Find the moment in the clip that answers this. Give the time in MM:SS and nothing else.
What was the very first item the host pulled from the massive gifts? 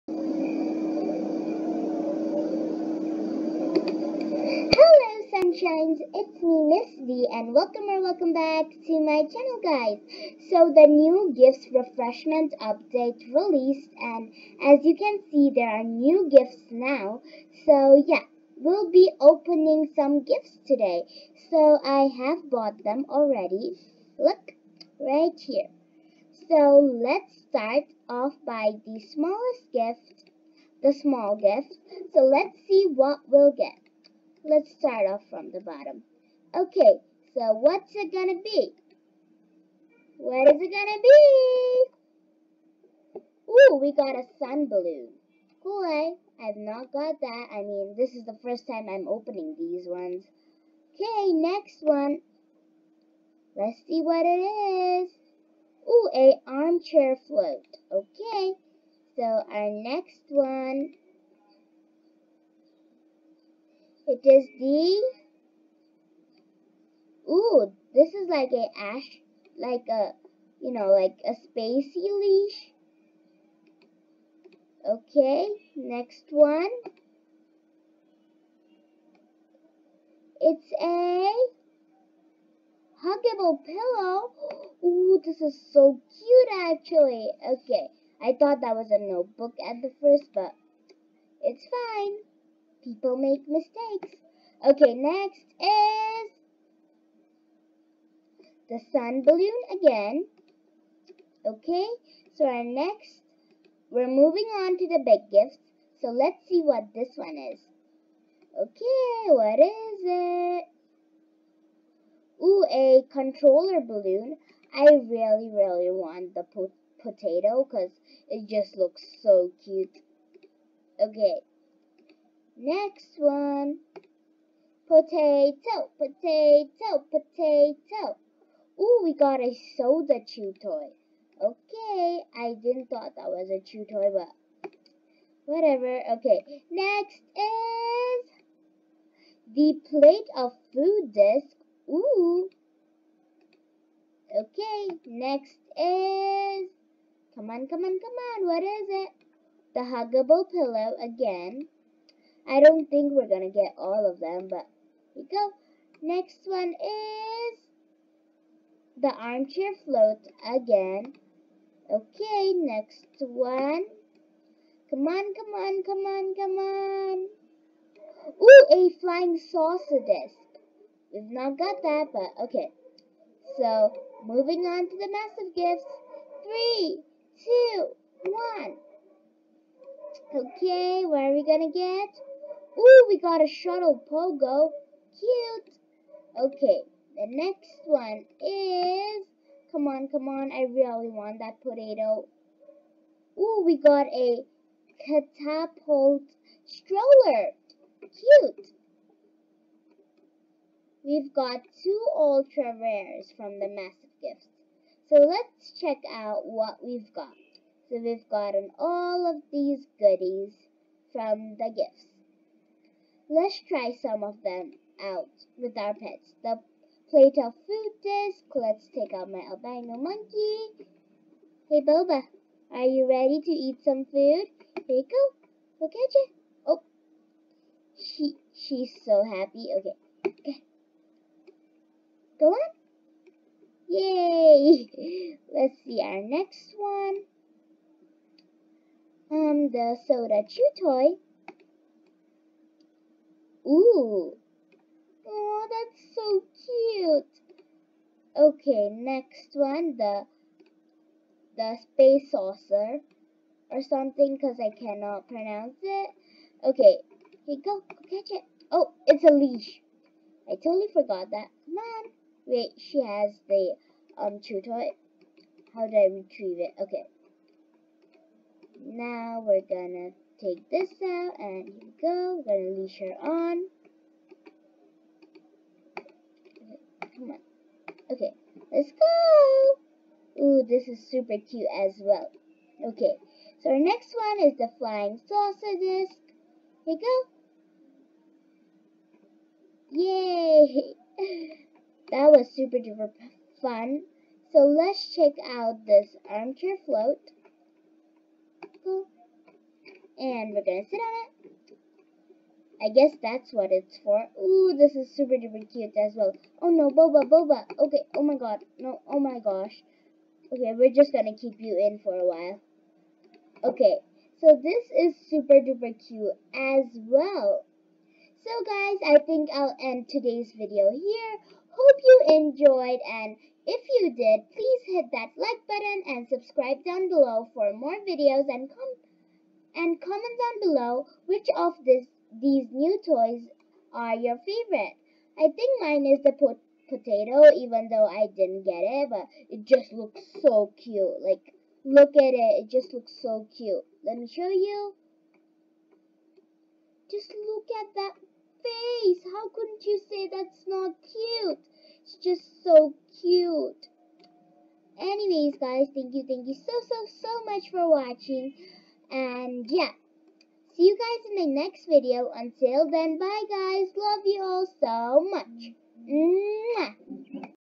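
03:03.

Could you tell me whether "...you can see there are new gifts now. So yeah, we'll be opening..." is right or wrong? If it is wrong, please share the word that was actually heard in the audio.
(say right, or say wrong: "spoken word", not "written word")
right.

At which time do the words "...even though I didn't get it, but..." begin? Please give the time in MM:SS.
05:37.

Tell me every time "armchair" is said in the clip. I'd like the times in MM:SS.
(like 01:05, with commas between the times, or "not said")
00:56, 02:39, 04:56.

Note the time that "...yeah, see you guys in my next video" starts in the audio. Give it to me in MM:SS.
05:59.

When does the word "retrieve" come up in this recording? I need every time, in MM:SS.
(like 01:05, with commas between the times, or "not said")
04:26.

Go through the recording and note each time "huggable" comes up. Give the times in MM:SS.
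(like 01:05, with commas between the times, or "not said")
01:23, 02:29.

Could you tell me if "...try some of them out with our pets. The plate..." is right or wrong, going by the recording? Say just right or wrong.
right.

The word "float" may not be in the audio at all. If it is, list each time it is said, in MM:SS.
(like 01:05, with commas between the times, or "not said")
00:57, 02:39, 04:56.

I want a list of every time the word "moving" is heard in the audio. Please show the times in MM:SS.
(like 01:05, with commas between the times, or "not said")
01:44, 02:54.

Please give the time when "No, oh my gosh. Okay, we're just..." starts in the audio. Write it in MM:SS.
05:08.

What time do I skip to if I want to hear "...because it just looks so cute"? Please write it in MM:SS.
01:57.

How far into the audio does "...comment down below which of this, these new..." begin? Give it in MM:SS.
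05:30.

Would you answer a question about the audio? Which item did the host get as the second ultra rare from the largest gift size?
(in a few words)
catapult stroller.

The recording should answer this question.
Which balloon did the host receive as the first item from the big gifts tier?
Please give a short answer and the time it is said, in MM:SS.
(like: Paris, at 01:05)
controller balloon, at 01:53.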